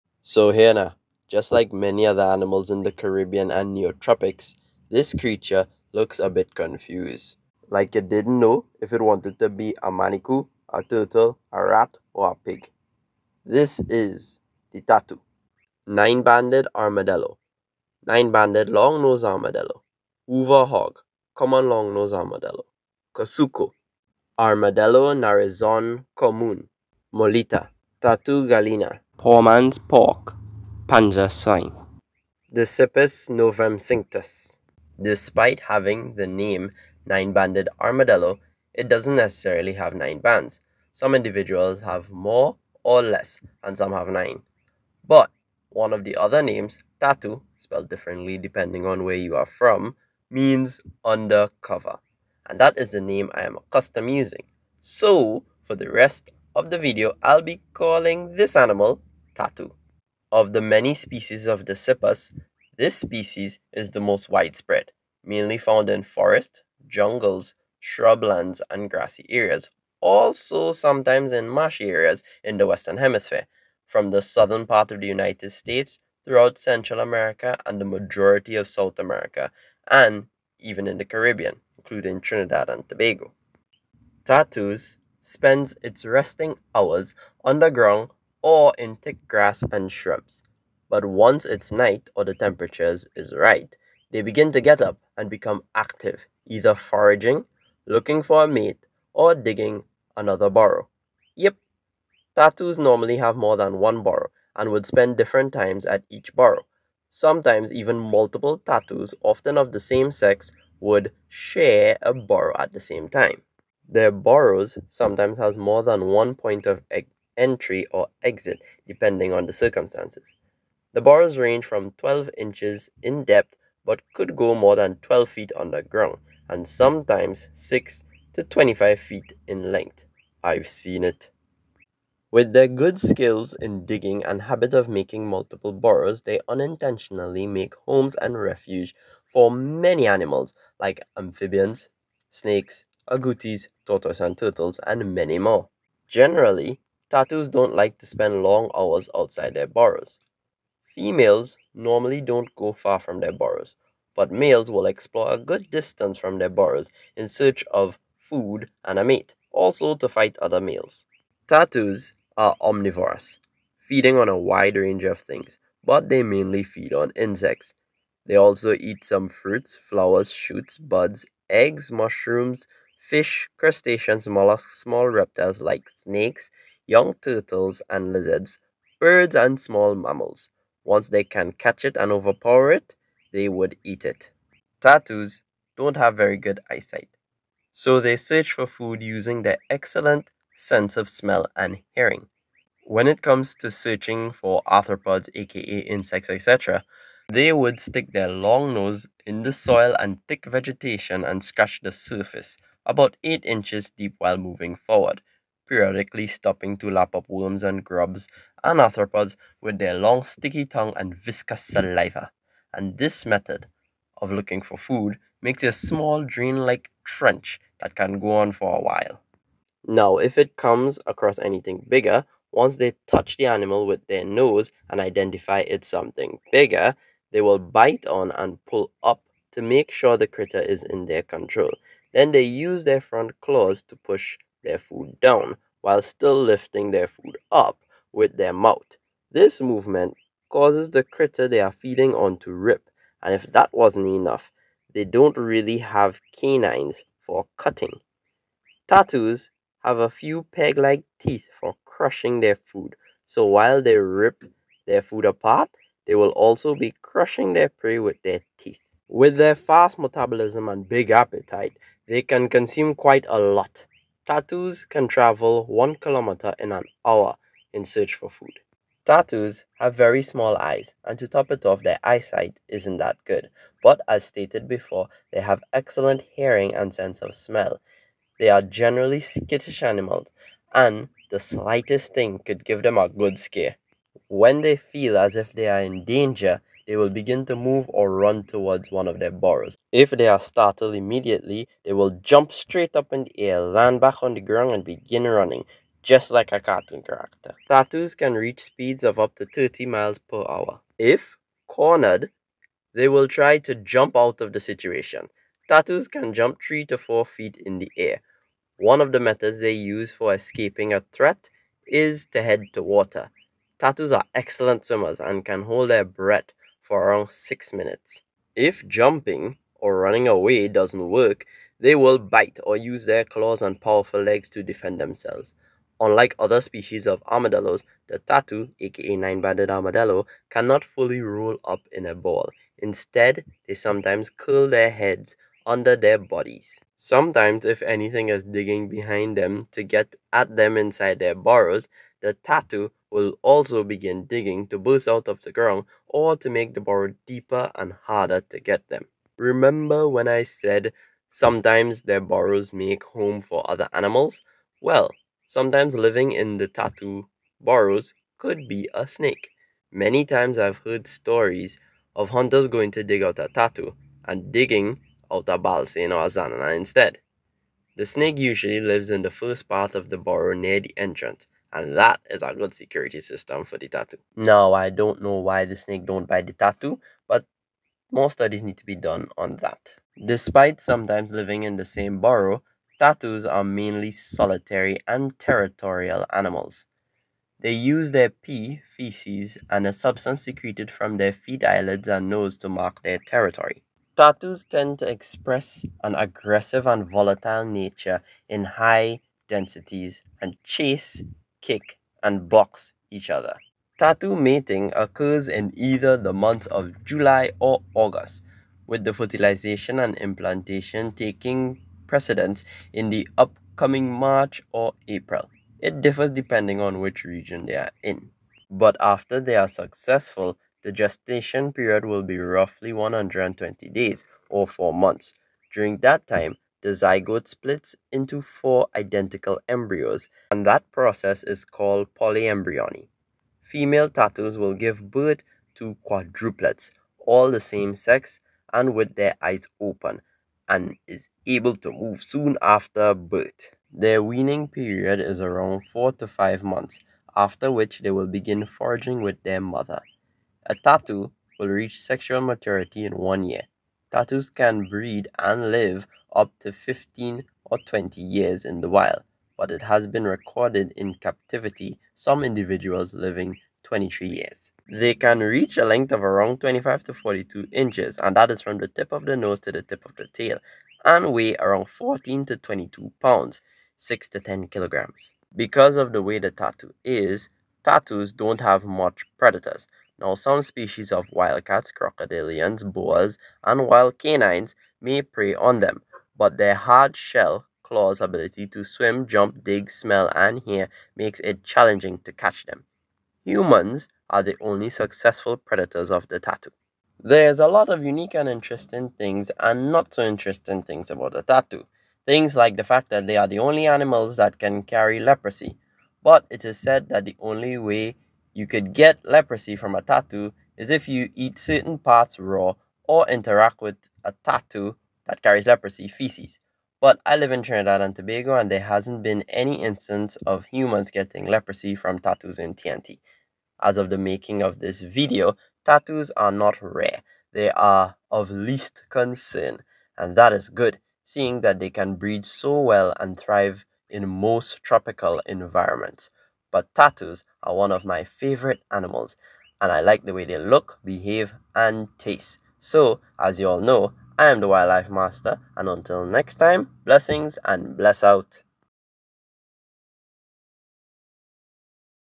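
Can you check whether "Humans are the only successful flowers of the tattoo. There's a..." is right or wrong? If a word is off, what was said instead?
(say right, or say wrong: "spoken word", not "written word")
wrong: "predators", not "flowers".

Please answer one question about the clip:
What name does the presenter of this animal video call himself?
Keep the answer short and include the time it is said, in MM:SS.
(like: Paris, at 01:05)
The Wildlife Master, at 09:04.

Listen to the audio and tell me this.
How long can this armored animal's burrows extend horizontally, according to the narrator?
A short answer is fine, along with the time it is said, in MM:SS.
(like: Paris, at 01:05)
6 to 25 feet, at 02:07.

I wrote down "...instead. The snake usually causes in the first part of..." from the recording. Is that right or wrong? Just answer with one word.
wrong.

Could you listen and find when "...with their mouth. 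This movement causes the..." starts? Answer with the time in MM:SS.
03:58.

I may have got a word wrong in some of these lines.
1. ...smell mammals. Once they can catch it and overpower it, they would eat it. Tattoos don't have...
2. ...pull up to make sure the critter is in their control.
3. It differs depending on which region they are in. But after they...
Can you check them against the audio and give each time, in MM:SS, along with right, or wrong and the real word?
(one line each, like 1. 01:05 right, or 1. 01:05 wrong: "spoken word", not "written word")
1. 02:59 wrong: "small", not "smell"
2. 03:48 right
3. 06:55 right.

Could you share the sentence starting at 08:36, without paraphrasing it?
But I live in Trinidad and Tobago and there hasn't been any instance of humans getting leprosy from tattoos in TNT.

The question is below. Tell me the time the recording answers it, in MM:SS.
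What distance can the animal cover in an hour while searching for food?
04:25.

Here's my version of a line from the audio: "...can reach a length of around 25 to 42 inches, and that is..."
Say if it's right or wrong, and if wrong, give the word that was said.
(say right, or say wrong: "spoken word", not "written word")
right.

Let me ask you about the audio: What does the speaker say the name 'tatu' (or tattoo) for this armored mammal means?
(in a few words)
Undercover.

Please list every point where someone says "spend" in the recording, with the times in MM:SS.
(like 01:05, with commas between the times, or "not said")
01:25, 01:44, 02:28.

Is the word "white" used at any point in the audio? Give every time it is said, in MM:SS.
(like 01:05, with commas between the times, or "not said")
not said.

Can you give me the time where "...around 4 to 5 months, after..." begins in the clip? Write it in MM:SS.
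07:25.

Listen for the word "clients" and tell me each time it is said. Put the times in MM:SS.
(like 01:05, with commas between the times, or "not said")
not said.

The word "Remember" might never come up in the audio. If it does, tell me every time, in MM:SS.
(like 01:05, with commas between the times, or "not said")
05:49.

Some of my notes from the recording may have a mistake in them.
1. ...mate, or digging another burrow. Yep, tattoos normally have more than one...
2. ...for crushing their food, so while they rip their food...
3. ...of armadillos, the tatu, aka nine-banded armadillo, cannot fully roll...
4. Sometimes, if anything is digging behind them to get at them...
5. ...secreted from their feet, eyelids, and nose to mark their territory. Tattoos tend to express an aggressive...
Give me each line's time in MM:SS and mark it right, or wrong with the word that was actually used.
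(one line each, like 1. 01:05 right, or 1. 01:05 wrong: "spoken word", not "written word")
1. 01:38 right
2. 04:11 right
3. 05:27 right
4. 05:36 right
5. 06:30 right.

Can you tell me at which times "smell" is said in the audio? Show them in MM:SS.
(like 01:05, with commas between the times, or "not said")
03:11, 04:37, 08:09.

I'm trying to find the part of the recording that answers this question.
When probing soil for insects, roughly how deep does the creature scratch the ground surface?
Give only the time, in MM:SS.
03:23.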